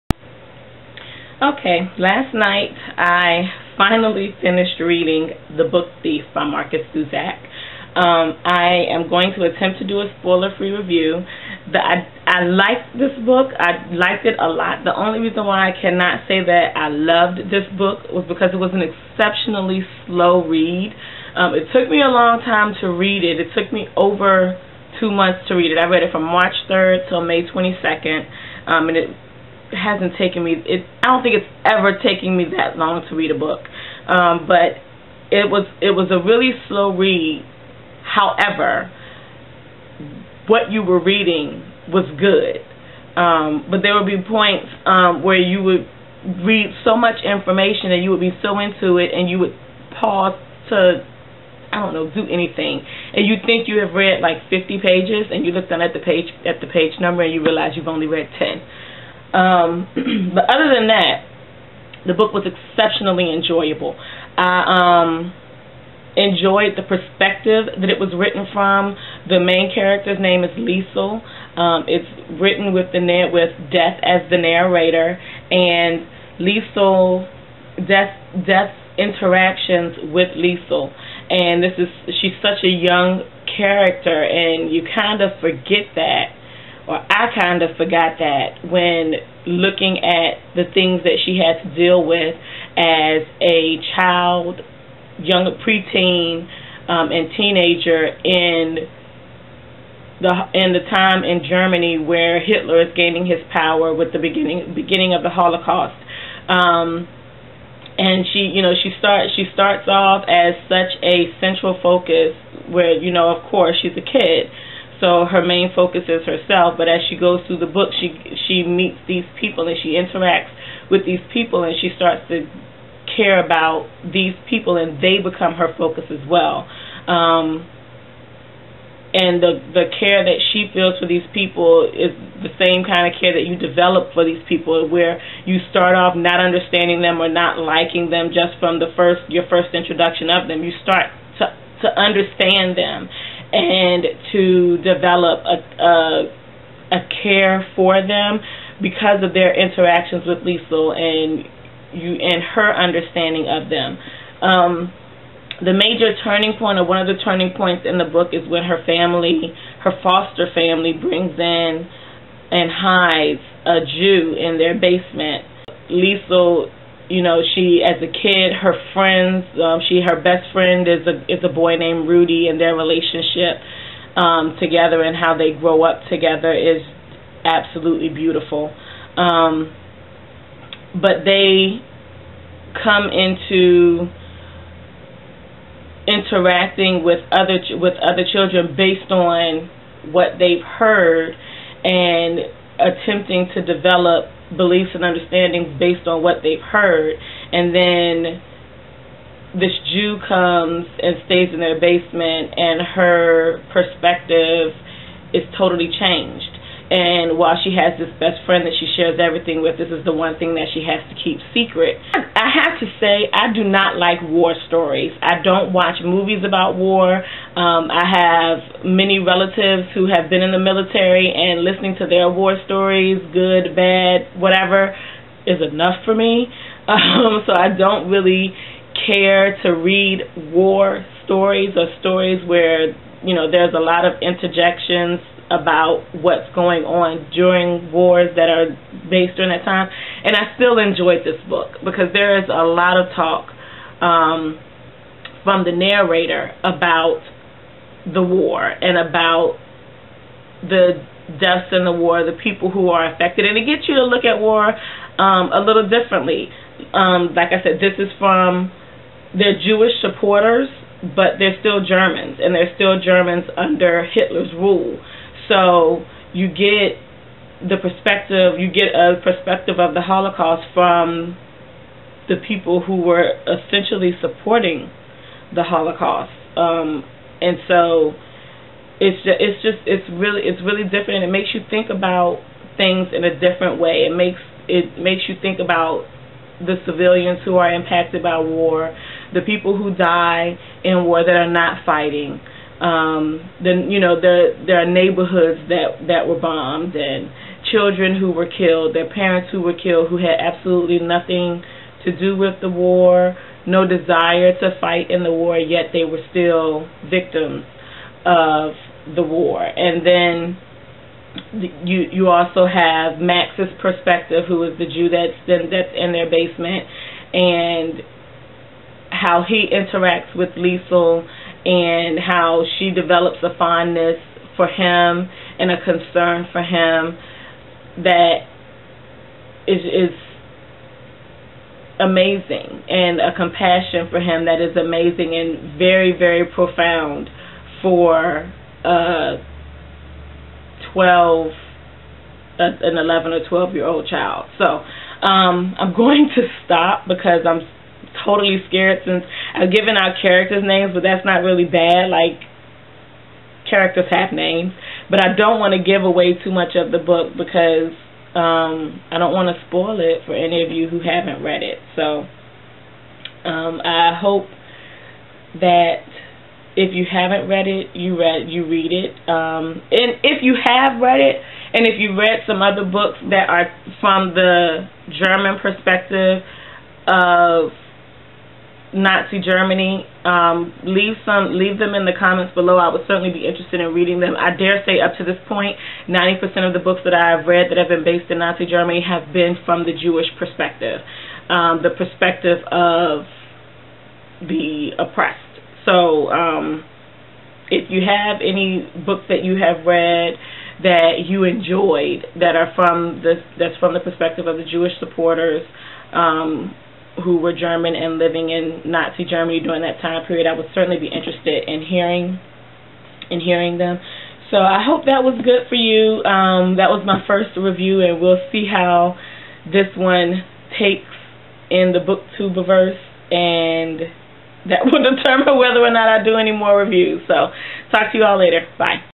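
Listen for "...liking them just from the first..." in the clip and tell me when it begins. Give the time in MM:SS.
02:17.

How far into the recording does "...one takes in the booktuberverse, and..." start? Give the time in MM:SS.
06:59.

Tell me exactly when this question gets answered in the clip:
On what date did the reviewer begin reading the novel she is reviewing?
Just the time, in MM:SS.
00:26.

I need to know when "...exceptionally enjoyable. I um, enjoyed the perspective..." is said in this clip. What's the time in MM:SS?
01:02.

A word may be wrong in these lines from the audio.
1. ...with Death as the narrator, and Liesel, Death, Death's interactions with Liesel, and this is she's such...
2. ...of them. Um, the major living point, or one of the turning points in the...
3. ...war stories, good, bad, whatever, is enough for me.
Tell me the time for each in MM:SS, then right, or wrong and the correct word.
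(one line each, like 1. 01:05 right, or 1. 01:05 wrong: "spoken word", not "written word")
1. 01:13 right
2. 02:33 wrong: "turning", not "living"
3. 03:42 right.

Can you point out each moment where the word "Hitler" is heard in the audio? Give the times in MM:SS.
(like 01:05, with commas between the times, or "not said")
01:42, 04:24.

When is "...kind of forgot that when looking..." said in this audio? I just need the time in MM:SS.
01:27.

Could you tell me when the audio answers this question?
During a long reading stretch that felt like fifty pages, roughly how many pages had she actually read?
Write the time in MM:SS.
00:58.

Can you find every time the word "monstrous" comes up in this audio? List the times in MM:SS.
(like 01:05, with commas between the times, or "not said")
not said.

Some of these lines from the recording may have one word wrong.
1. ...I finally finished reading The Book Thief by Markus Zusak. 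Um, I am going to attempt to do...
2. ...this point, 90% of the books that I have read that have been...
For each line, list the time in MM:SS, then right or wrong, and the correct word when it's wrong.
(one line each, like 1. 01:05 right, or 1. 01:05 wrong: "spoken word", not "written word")
1. 00:03 right
2. 06:25 right.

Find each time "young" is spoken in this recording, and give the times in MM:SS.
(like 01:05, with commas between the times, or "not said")
01:22, 01:35.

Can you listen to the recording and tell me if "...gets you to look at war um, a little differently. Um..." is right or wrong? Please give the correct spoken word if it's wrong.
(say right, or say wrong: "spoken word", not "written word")
right.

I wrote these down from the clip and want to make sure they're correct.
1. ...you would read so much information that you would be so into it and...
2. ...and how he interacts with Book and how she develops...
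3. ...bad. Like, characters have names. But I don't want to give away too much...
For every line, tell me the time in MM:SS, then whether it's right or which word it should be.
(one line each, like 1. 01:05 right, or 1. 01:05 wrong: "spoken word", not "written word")
1. 00:45 right
2. 05:17 wrong: "Liesel", not "Book"
3. 05:51 right.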